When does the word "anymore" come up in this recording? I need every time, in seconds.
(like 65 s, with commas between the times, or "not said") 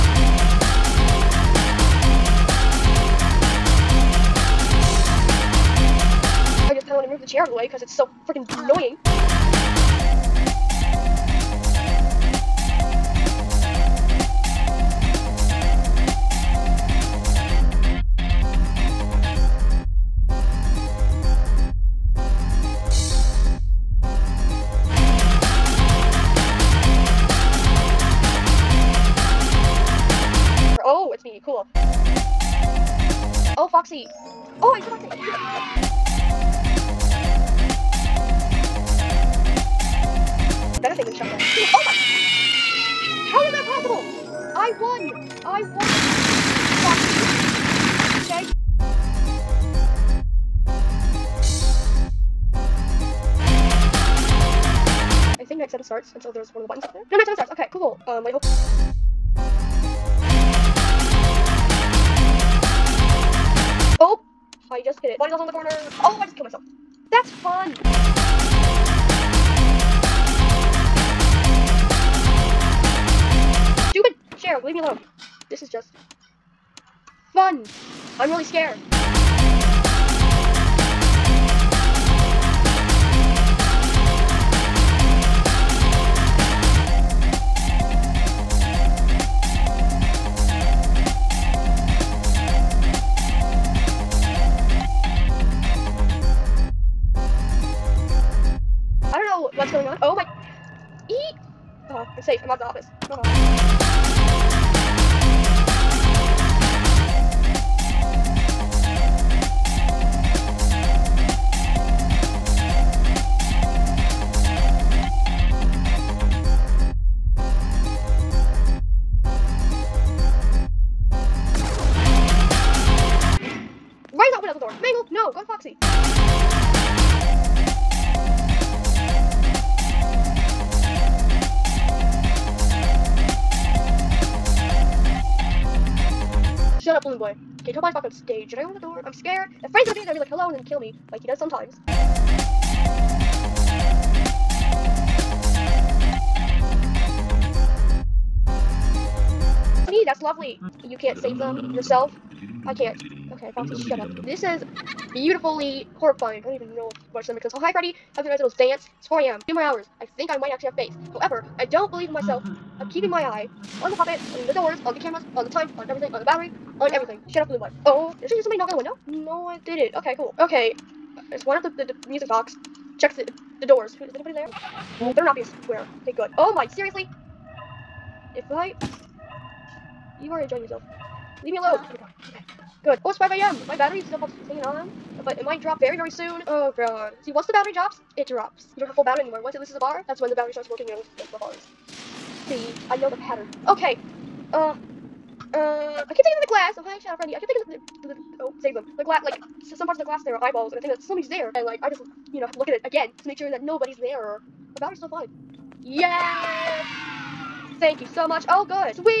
189 s.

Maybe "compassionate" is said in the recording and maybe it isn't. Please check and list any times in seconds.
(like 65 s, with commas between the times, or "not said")
not said.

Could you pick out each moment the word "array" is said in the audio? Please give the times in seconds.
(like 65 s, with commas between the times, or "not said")
not said.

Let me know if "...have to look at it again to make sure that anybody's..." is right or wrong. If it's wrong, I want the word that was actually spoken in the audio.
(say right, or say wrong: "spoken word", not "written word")
wrong: "nobody", not "anybody".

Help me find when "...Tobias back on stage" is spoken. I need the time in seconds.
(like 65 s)
137 s.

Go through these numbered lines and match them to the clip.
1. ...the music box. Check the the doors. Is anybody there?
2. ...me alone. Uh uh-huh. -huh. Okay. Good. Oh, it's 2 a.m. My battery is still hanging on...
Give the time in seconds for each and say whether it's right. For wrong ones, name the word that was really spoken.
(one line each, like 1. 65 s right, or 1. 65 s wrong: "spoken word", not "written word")
1. 172 s right
2. 181 s wrong: "5", not "2".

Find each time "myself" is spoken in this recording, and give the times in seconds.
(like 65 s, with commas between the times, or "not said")
66 s, 162 s.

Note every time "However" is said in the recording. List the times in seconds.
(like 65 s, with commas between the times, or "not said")
161 s.